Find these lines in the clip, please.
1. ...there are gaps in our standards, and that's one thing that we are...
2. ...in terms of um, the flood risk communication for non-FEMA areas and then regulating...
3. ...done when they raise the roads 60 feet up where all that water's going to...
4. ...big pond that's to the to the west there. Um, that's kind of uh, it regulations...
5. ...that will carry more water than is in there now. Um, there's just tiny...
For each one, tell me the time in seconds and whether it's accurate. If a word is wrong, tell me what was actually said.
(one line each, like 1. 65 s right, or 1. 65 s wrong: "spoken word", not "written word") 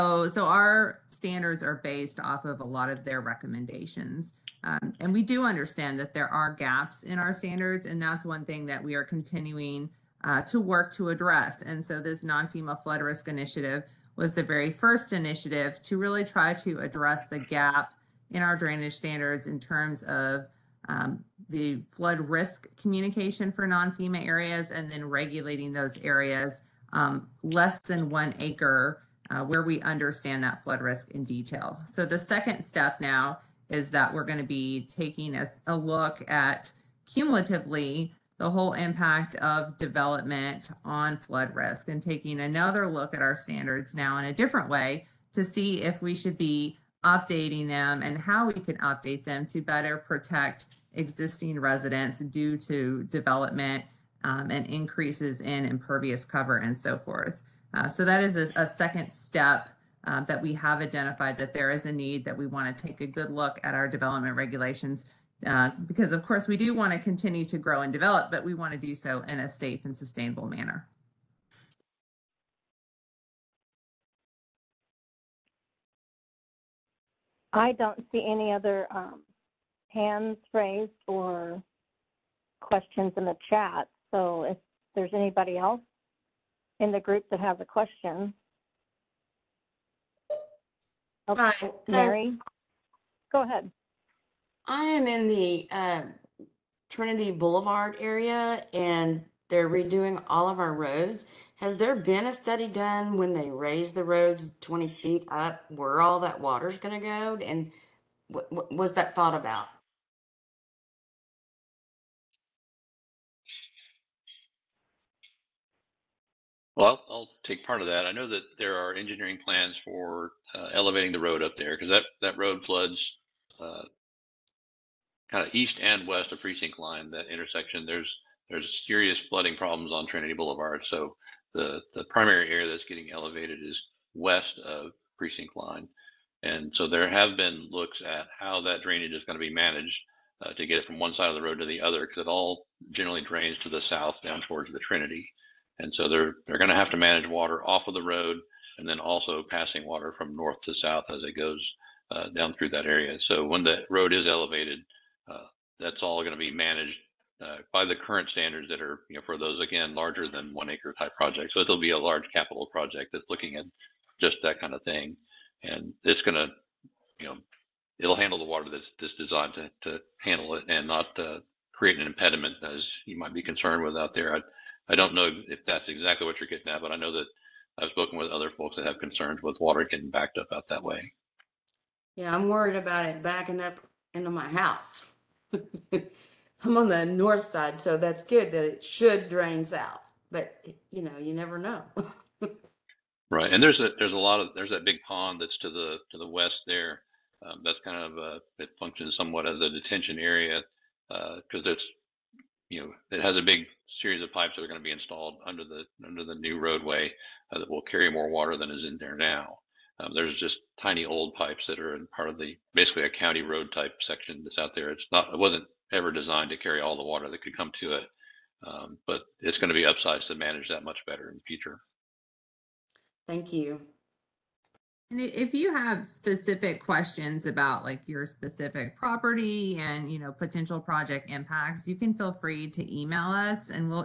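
1. 6 s right
2. 19 s right
3. 102 s wrong: "20", not "60"
4. 194 s wrong: "functions", not "regulations"
5. 207 s right.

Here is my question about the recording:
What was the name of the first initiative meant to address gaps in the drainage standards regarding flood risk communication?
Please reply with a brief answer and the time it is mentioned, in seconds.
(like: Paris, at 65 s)
non-FEMA flood risk initiative, at 12 s.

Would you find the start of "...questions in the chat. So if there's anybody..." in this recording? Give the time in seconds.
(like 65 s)
82 s.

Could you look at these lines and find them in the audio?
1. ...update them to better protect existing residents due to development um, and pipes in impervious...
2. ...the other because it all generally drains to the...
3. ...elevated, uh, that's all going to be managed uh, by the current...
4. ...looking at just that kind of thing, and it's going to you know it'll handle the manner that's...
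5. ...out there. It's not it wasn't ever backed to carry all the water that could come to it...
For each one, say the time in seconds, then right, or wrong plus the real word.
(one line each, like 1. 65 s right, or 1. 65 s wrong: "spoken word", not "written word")
1. 48 s wrong: "increases", not "pipes"
2. 141 s right
3. 154 s right
4. 163 s wrong: "water", not "manner"
5. 214 s wrong: "designed", not "backed".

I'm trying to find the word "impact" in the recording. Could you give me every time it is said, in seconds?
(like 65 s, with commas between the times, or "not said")
38 s, 231 s.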